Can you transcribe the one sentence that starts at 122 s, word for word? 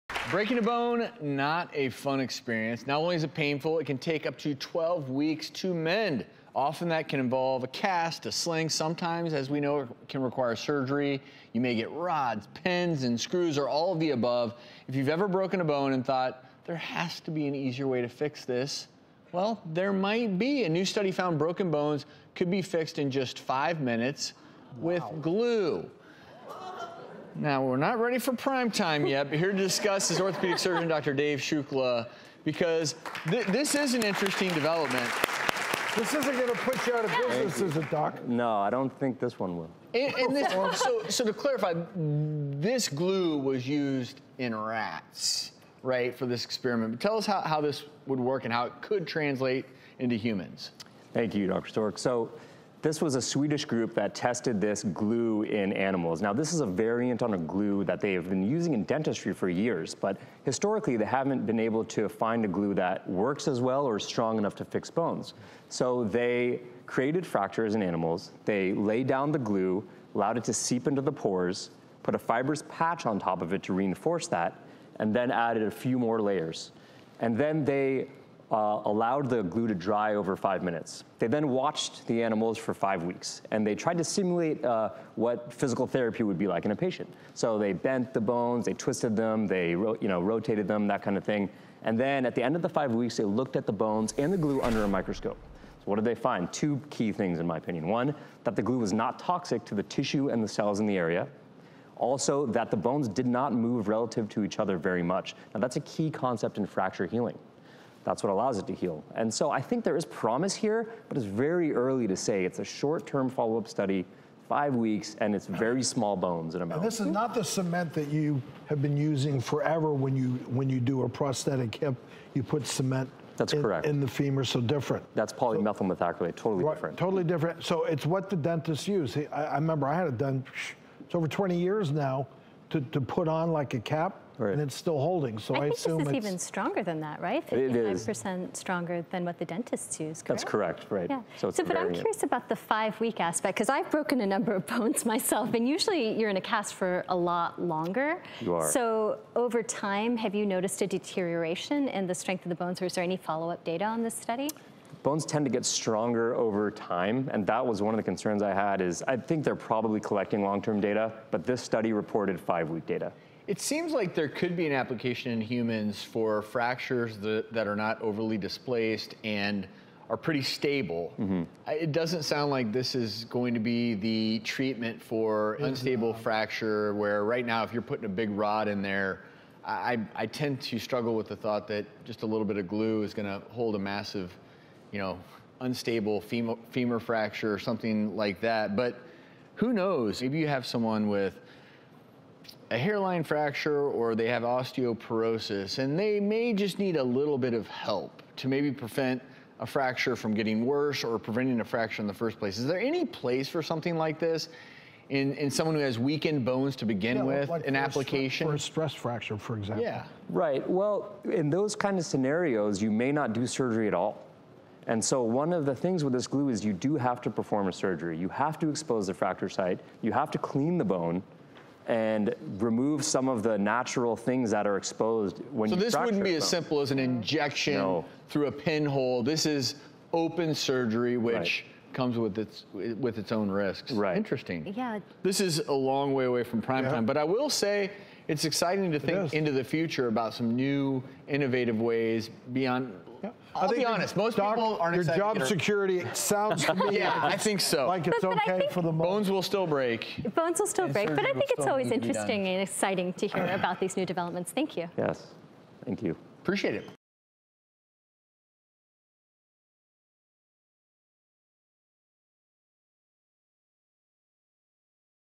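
You put cement that's in, correct.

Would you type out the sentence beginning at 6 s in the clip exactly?
Often that can involve a cast, a sling.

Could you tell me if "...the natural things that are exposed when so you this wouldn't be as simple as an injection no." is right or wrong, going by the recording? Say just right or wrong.
right.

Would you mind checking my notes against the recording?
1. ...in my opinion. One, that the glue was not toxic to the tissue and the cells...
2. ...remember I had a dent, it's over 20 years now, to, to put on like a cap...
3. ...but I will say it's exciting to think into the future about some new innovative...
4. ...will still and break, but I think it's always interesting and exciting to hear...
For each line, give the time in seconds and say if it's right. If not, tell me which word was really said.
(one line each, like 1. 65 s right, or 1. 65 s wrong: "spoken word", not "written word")
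1. 97 s right
2. 129 s right
3. 237 s right
4. 250 s right.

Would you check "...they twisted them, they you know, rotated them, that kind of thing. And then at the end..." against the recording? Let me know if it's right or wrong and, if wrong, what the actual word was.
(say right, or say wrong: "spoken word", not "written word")
right.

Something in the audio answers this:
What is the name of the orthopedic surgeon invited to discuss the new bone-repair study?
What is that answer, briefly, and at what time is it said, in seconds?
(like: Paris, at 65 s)
Dave Shukla, at 30 s.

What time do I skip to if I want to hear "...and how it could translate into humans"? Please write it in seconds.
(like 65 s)
48 s.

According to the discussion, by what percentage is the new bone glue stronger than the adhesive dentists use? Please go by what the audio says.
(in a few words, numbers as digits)
55%.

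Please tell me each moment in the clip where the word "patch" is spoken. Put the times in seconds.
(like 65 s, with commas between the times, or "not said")
72 s.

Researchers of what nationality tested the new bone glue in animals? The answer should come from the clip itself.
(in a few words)
Swedish.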